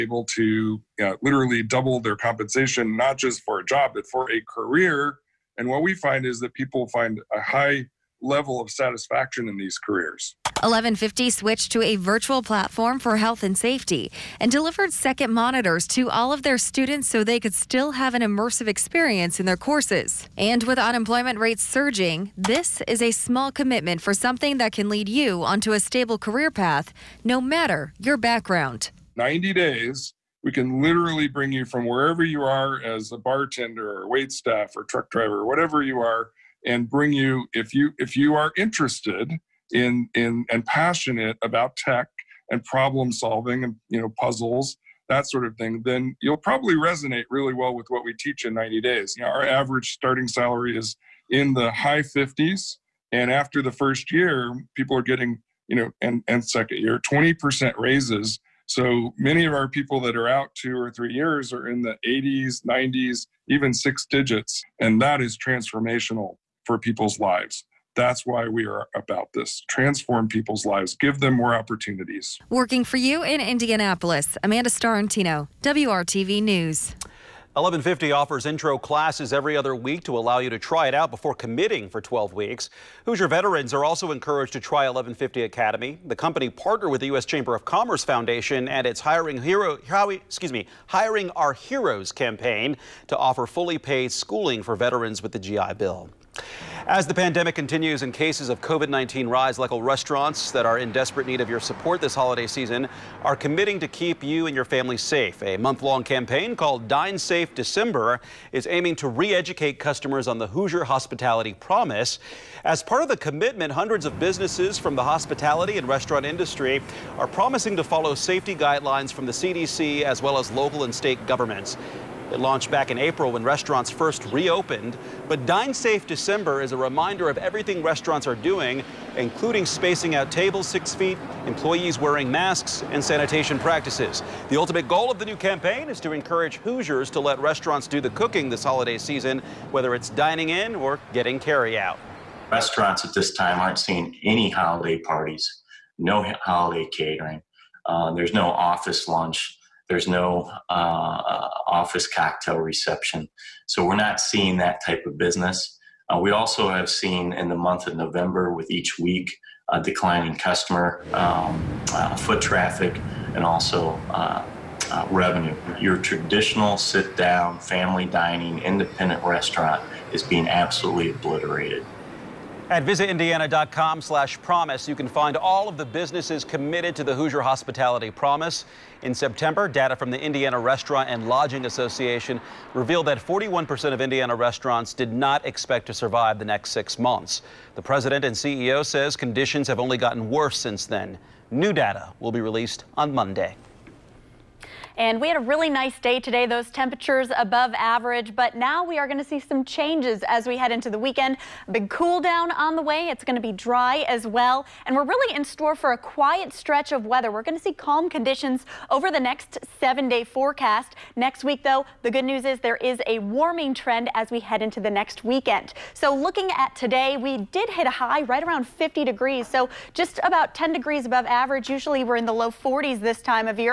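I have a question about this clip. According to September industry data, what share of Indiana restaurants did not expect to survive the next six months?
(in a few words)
41%.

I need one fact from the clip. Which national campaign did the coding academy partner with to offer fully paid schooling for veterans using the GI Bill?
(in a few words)
Hiring Our Heroes.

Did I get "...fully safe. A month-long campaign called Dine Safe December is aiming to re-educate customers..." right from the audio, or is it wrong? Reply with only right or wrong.
wrong.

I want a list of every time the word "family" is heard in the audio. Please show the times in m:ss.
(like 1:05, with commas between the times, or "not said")
1:44, 2:47.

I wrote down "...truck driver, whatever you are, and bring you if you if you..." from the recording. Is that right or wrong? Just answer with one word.
right.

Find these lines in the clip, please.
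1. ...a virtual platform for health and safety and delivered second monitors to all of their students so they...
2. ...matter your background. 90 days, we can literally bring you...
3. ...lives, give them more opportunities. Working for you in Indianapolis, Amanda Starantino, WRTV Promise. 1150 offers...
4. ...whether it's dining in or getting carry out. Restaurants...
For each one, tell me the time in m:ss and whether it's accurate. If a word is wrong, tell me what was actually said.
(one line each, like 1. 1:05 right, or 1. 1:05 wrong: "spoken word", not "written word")
1. 0:11 right
2. 0:27 right
3. 1:10 wrong: "News", not "Promise"
4. 2:19 right.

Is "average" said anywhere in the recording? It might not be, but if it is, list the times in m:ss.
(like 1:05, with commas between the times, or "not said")
0:49, 3:17, 3:41.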